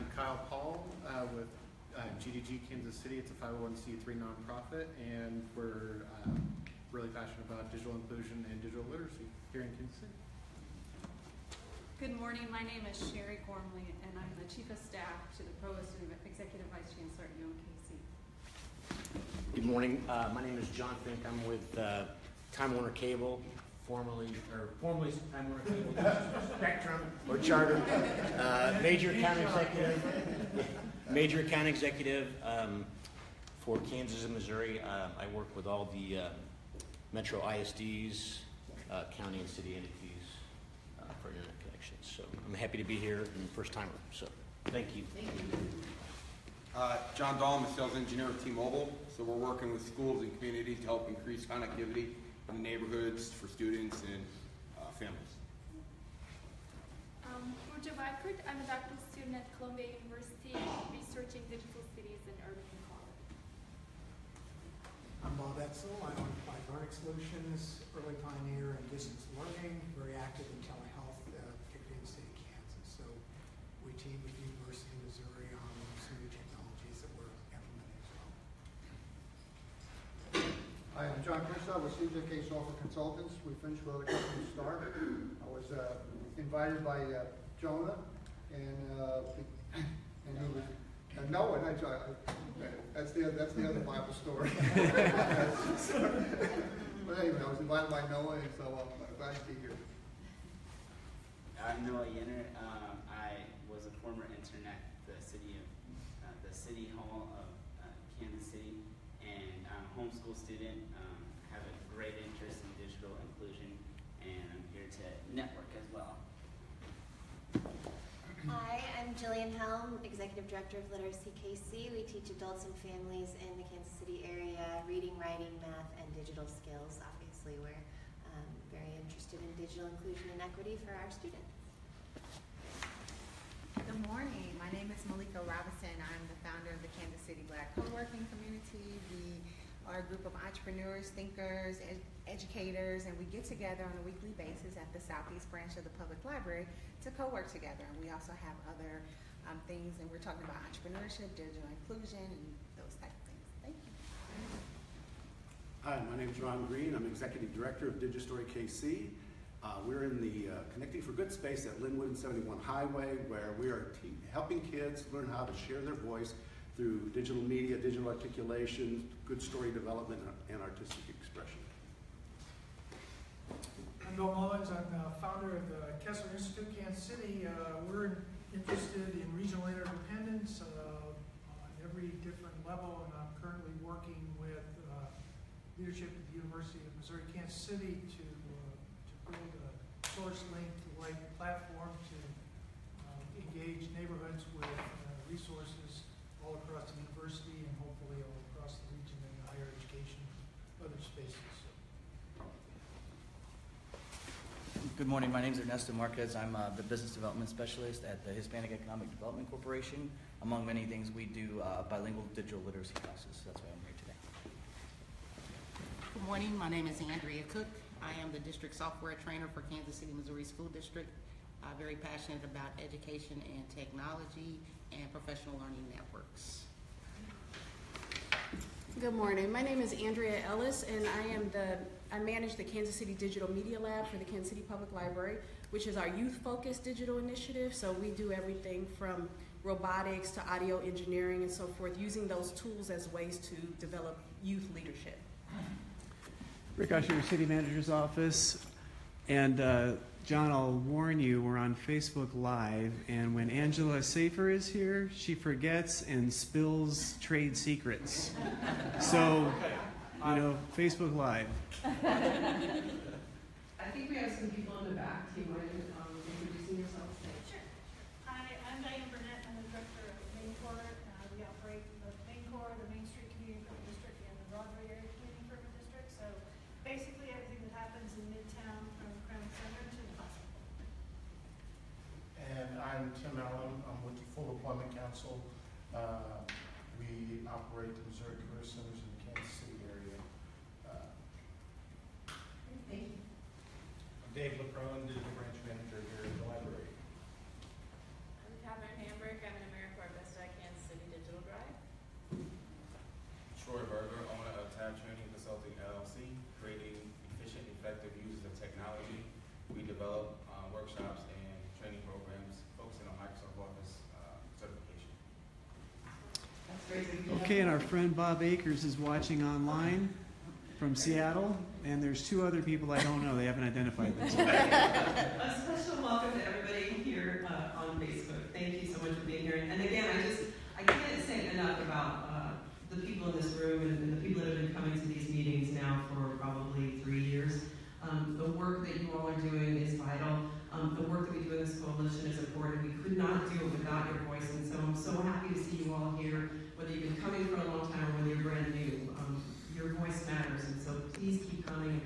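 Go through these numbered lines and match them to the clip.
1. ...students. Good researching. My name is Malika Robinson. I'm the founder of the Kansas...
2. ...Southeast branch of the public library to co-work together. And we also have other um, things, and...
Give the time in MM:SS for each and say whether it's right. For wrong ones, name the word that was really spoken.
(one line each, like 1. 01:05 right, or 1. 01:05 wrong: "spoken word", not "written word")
1. 02:11 wrong: "morning", not "researching"
2. 02:25 right.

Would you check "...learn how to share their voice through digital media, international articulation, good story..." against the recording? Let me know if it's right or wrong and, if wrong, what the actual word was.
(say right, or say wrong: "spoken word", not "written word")
wrong: "digital", not "international".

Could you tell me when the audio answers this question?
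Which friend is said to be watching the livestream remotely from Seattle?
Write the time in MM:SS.
05:18.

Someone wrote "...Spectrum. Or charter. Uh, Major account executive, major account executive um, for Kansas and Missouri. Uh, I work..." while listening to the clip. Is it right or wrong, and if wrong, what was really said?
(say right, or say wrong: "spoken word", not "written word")
right.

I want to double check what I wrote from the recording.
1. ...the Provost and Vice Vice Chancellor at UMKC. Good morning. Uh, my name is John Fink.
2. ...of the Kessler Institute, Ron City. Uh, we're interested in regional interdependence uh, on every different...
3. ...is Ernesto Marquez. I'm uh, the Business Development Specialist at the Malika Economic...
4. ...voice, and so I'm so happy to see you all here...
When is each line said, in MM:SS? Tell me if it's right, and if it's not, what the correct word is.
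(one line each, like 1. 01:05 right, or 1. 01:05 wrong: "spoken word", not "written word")
1. 00:15 wrong: "Executive", not "Vice"
2. 02:55 wrong: "Kansas", not "Ron"
3. 03:25 wrong: "Hispanic", not "Malika"
4. 05:44 right.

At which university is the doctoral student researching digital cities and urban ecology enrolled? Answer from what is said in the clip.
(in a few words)
Columbia University.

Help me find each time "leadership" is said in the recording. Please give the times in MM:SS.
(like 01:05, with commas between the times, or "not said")
03:05, 04:04.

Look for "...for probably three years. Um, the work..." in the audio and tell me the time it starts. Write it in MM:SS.
05:36.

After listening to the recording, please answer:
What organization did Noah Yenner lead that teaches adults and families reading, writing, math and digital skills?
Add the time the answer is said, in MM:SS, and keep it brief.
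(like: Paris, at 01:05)
Literacy KC, at 02:01.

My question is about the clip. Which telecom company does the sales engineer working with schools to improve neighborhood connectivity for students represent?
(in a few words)
T-Mobile.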